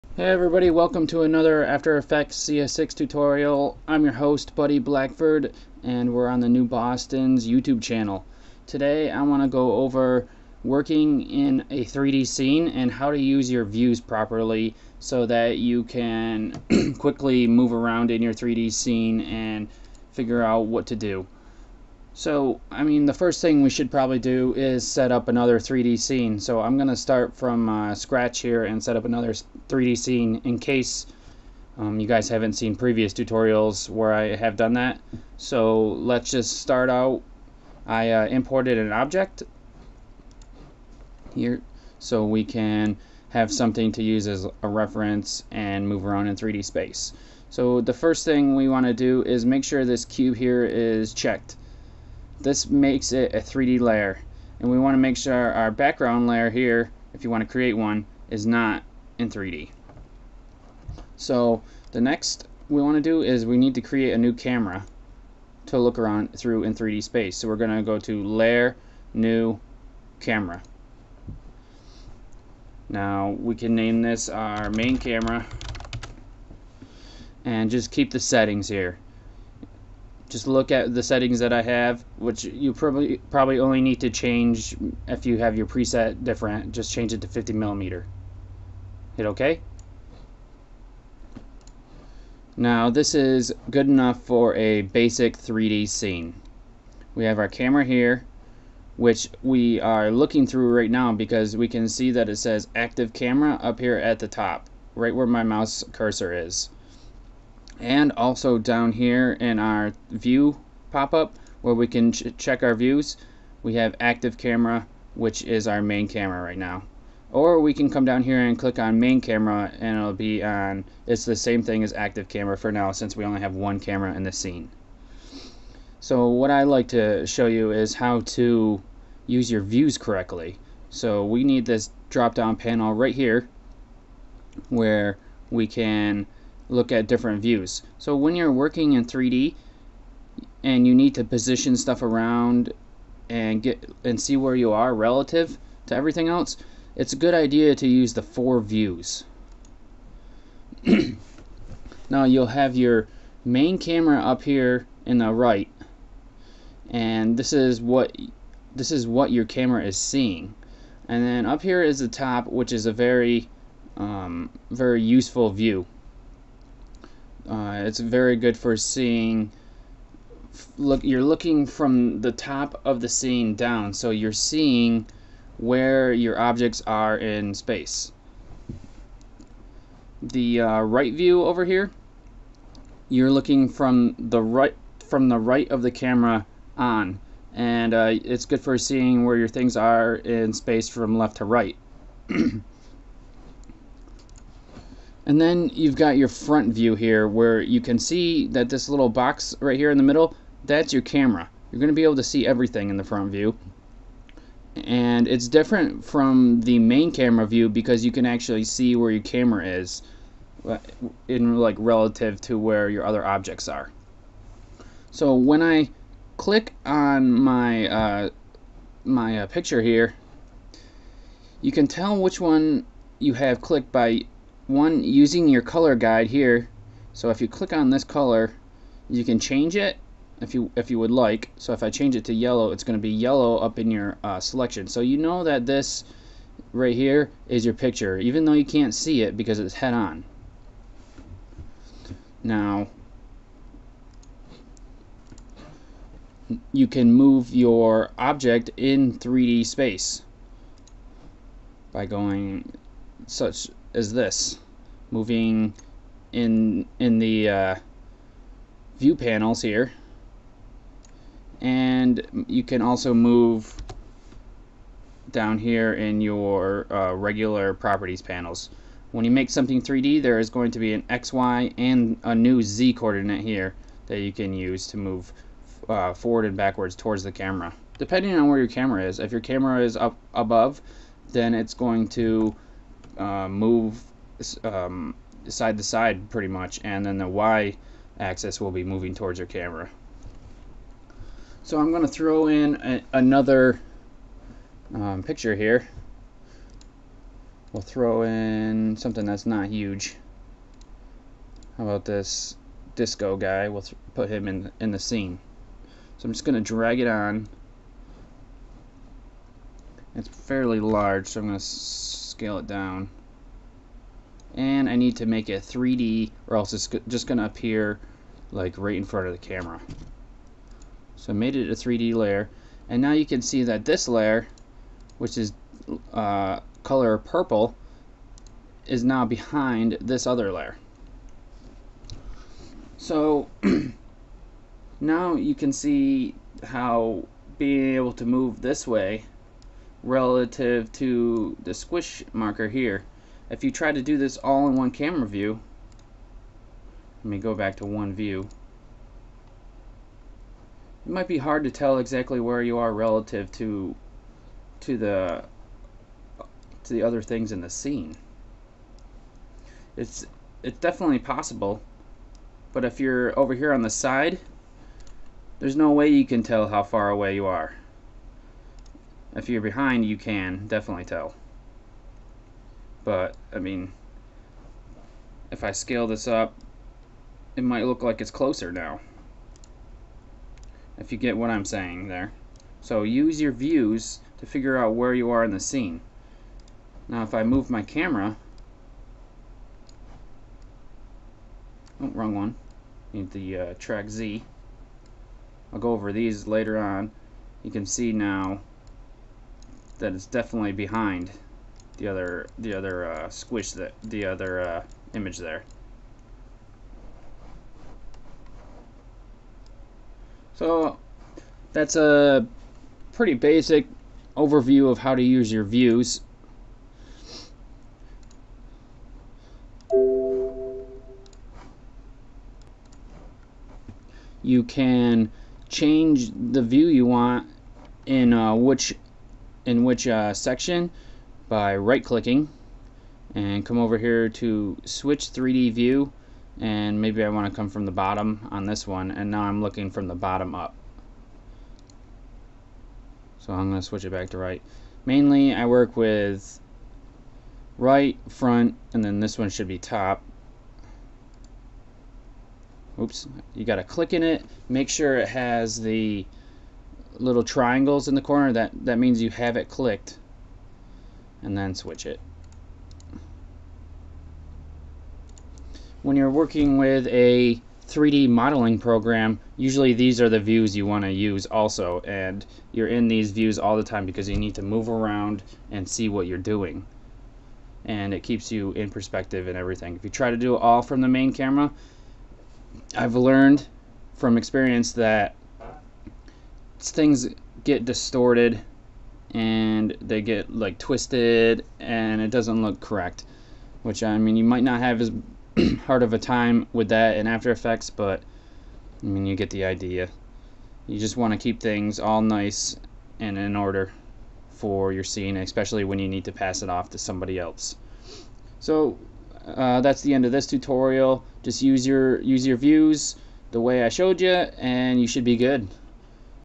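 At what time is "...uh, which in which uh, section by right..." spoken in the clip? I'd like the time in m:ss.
7:08.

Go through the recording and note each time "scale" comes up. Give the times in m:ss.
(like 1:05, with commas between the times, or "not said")
5:11, 6:15.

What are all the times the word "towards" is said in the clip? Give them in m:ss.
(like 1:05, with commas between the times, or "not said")
4:36, 4:49.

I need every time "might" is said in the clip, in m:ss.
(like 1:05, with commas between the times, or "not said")
5:51, 6:17, 8:14.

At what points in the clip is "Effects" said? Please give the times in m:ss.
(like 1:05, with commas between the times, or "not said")
0:01, 8:17.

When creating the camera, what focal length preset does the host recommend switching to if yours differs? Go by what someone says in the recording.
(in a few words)
50 millimeter.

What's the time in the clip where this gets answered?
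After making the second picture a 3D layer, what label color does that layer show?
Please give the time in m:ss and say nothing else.
5:27.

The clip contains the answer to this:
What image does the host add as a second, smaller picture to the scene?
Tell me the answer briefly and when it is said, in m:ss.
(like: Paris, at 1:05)
disco guy, at 5:02.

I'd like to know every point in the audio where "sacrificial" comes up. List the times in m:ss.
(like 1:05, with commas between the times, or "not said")
not said.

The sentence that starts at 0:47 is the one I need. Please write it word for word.
So the first thing we want to do is make sure this cube here is checked this makes it a 3D layer.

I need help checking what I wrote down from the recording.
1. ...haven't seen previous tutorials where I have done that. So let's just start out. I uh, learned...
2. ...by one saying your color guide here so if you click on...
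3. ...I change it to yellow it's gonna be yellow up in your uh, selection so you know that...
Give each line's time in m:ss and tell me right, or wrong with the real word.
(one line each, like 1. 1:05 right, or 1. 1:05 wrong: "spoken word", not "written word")
1. 0:32 wrong: "imported", not "learned"
2. 3:43 wrong: "using", not "saying"
3. 3:51 right.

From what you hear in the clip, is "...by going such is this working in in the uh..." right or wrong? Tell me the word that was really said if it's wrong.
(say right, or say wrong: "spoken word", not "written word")
wrong: "moving", not "working".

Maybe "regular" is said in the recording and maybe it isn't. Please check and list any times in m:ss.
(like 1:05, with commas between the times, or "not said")
4:27.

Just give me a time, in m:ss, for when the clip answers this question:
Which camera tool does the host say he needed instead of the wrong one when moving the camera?
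6:33.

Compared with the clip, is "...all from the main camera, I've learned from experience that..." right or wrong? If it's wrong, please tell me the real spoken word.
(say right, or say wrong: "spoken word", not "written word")
right.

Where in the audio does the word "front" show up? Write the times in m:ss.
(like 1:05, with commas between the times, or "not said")
3:16, 3:23, 5:19, 7:28.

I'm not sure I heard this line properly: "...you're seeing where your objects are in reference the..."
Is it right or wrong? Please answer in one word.
wrong.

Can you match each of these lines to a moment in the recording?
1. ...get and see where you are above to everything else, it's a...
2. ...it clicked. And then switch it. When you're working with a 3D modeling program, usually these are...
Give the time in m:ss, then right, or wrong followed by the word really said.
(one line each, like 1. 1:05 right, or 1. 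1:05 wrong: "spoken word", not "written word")
1. 2:23 wrong: "relative", not "above"
2. 7:39 right.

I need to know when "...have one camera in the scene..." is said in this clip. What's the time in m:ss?
2:03.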